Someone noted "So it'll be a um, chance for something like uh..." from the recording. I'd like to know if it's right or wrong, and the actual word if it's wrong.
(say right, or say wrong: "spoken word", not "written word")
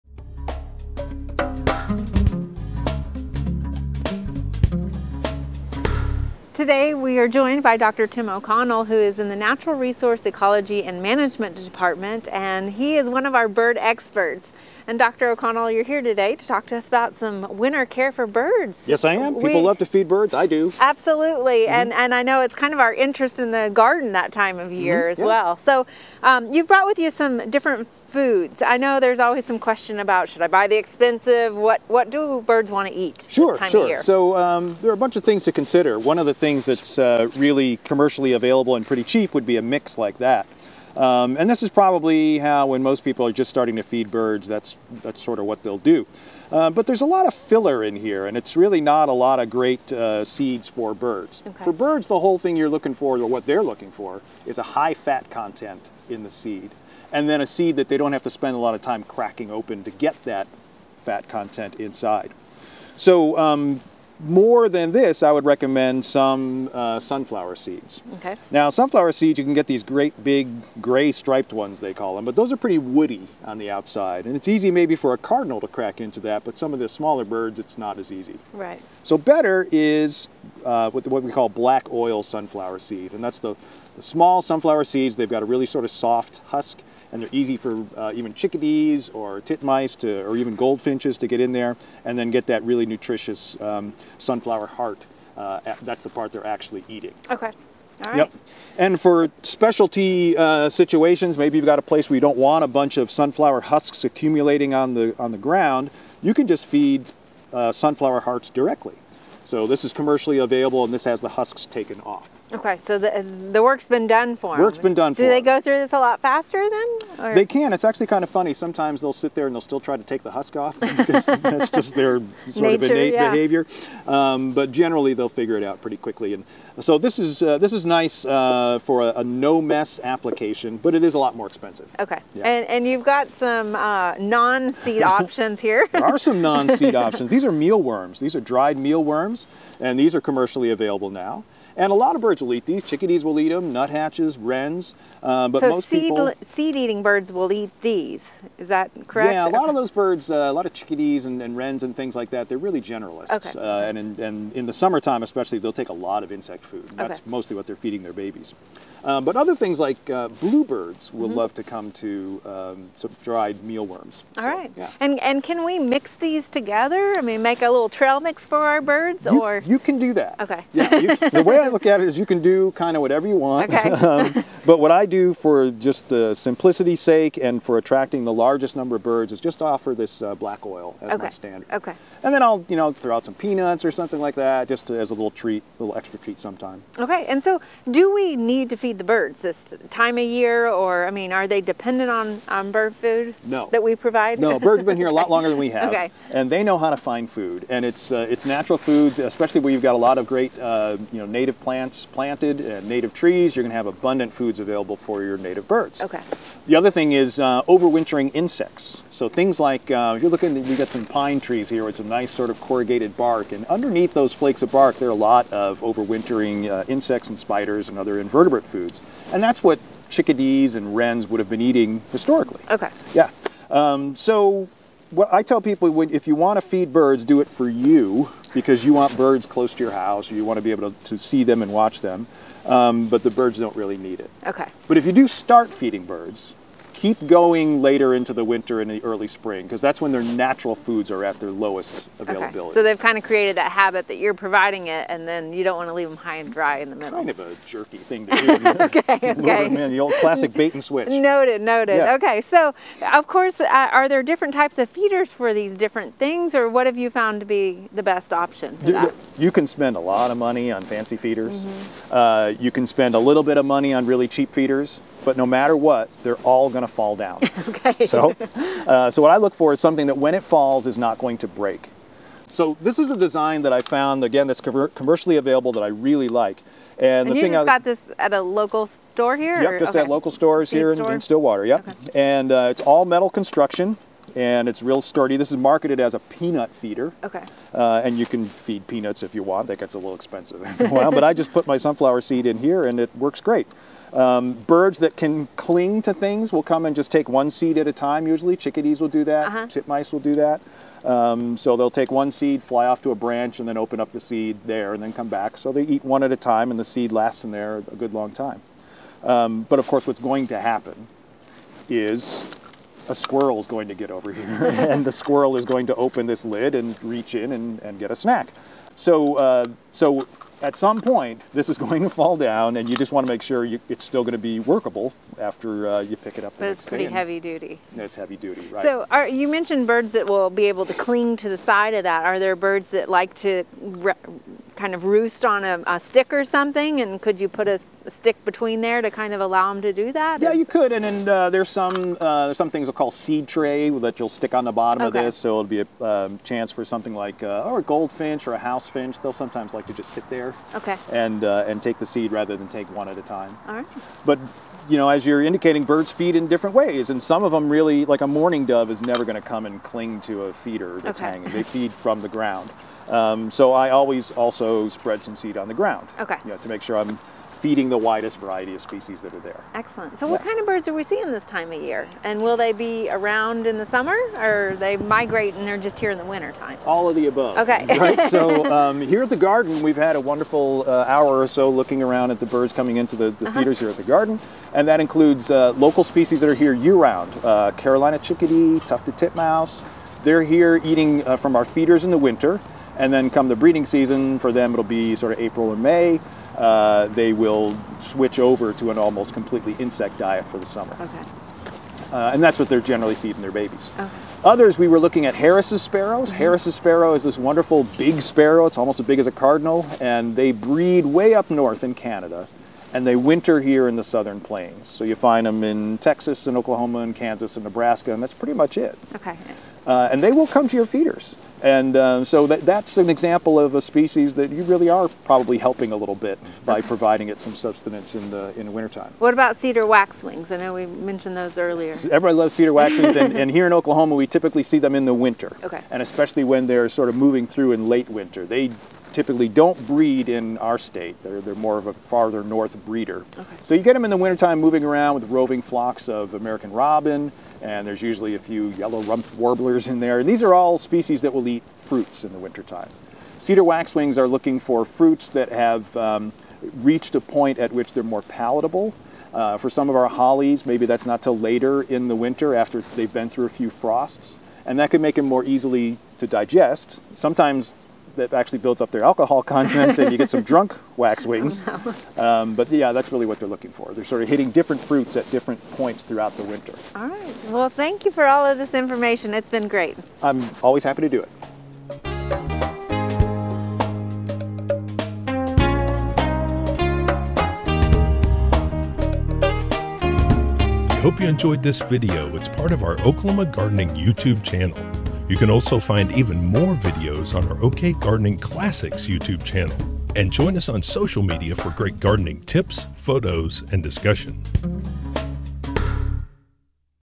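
right.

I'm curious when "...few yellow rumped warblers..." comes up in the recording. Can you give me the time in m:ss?
7:28.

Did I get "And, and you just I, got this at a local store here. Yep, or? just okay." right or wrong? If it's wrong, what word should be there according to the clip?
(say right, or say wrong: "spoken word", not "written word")
right.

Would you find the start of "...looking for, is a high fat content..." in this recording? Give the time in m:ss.
0:53.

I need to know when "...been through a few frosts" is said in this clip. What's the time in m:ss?
7:43.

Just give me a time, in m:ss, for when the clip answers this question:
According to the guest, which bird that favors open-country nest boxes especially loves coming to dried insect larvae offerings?
2:40.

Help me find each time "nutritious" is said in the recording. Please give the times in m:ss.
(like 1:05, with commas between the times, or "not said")
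1:32.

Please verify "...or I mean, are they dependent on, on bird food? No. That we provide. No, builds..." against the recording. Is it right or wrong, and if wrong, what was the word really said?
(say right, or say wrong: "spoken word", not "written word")
wrong: "birds", not "builds".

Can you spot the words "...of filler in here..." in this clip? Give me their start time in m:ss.
0:47.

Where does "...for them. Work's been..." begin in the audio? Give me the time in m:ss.
1:54.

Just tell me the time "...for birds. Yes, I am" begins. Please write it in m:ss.
0:18.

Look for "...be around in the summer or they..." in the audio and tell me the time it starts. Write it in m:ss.
6:12.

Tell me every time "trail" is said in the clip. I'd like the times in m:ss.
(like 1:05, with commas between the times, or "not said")
2:47.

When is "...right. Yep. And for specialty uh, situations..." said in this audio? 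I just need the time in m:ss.
1:38.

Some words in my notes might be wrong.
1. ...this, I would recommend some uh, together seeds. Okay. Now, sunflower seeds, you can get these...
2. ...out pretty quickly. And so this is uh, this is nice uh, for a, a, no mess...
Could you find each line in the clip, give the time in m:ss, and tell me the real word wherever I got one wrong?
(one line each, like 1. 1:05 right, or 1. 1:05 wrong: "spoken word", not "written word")
1. 1:04 wrong: "sunflower", not "together"
2. 2:05 right.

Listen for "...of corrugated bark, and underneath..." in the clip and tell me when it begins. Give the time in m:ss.
3:32.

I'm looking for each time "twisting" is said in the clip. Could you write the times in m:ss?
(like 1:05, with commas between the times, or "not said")
not said.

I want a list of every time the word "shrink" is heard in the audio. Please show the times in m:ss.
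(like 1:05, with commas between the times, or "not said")
not said.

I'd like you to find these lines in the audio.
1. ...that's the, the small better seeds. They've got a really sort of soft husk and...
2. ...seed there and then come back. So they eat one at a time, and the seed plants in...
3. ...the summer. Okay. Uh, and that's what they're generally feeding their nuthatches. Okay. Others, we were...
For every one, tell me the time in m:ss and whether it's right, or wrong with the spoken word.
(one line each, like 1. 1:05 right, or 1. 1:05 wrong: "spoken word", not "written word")
1. 1:23 wrong: "sunflower", not "better"
2. 5:04 wrong: "lasts", not "plants"
3. 6:40 wrong: "babies", not "nuthatches".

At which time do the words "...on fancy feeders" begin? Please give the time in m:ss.
4:20.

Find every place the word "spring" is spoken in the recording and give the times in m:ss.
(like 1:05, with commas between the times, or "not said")
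3:59.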